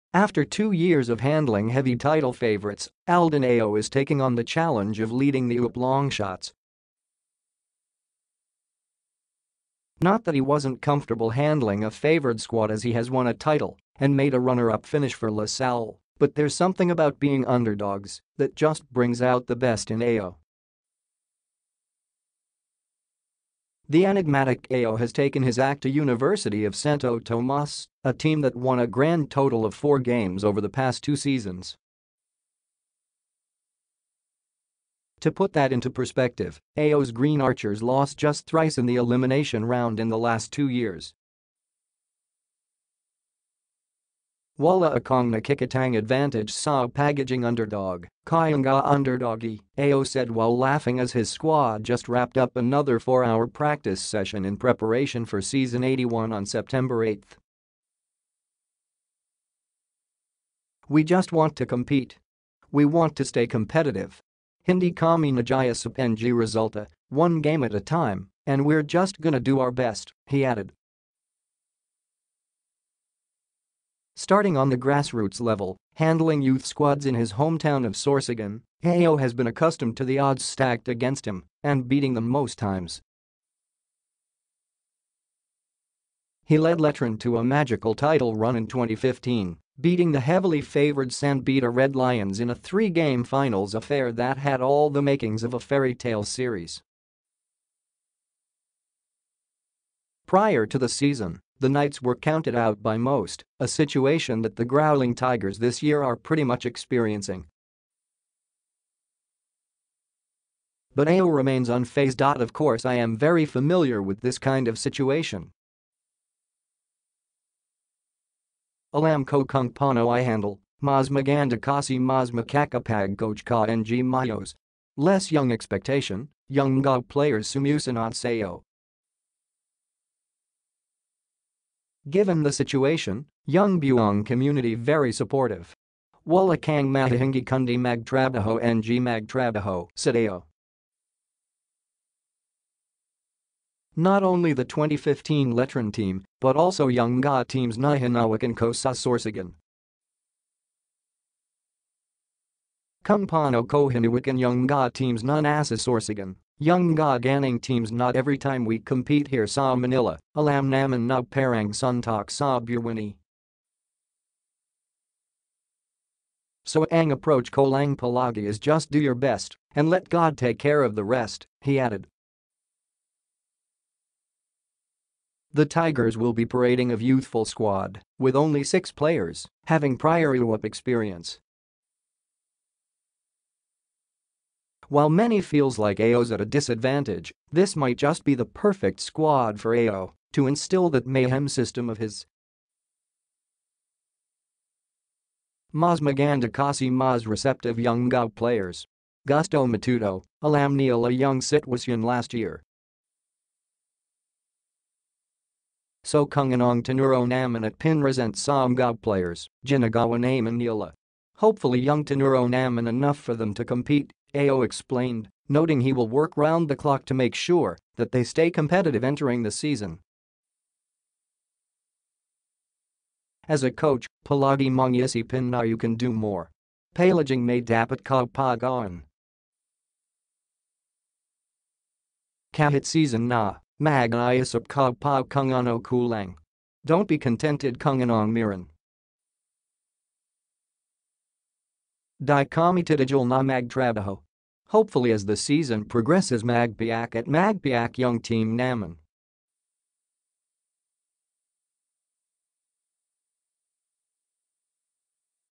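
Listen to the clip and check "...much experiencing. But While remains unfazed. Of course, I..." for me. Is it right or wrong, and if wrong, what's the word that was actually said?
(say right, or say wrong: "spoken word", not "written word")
wrong: "Ayo", not "While".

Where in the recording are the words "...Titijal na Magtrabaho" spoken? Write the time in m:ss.
4:02.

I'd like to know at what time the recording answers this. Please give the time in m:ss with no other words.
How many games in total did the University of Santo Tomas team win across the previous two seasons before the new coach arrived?
0:29.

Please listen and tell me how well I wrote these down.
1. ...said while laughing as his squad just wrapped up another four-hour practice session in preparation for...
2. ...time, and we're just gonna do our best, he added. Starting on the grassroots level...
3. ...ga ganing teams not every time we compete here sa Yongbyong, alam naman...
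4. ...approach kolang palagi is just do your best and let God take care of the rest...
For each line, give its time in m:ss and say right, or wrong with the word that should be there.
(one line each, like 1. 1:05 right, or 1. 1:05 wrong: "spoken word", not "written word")
1. 0:50 right
2. 1:07 right
3. 2:36 wrong: "Manila", not "Yongbyong"
4. 2:47 right.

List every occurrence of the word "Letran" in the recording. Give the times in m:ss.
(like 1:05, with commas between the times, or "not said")
1:26, 2:25.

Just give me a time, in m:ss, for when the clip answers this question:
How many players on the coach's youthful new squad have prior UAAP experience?
2:58.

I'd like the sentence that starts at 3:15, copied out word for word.
Mazmagandakasi Maz receptive young Gao players.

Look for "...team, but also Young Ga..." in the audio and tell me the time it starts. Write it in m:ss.
2:25.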